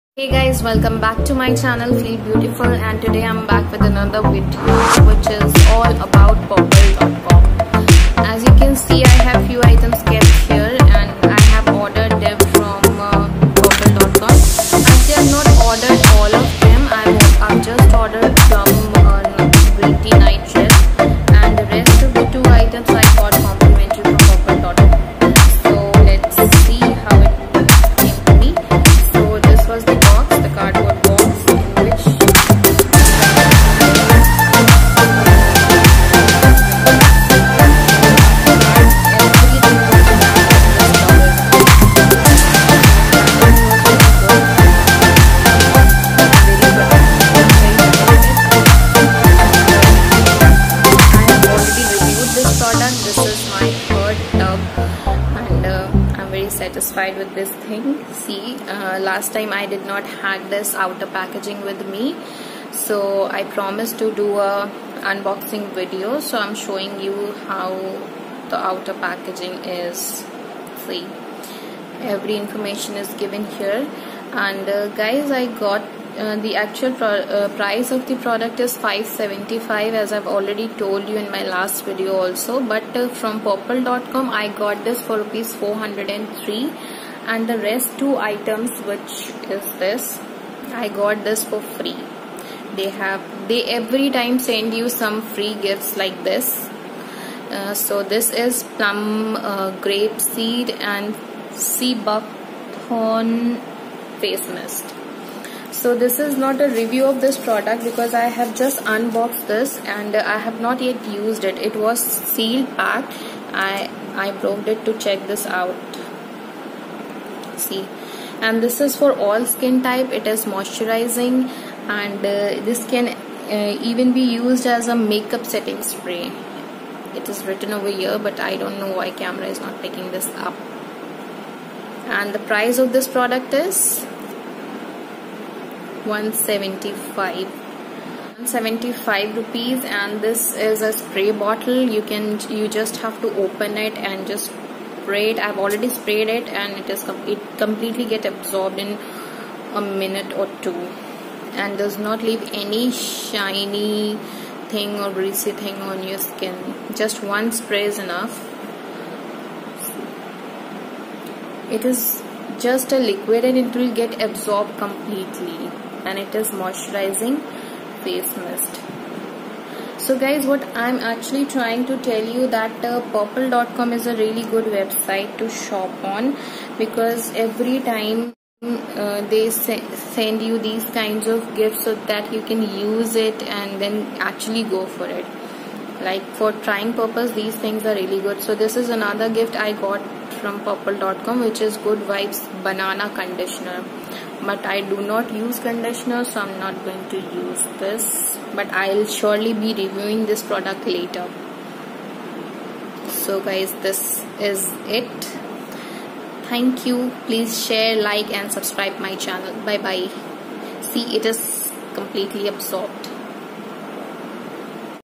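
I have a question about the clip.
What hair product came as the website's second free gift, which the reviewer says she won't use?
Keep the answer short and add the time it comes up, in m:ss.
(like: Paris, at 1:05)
good vibes banana conditioner, at 3:11.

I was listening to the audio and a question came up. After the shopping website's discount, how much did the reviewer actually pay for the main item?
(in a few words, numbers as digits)
403 rupees.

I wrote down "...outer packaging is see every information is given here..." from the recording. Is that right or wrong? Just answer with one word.
right.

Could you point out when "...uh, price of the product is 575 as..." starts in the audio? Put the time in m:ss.
1:17.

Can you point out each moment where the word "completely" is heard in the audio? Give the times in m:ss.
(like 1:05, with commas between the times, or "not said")
2:27, 2:44, 3:31.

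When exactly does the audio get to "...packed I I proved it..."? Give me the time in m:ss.
1:52.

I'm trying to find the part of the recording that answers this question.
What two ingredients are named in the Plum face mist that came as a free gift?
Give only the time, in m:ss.
1:39.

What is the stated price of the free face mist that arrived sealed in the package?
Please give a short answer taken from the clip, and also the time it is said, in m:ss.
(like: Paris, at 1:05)
175 rupees, at 2:17.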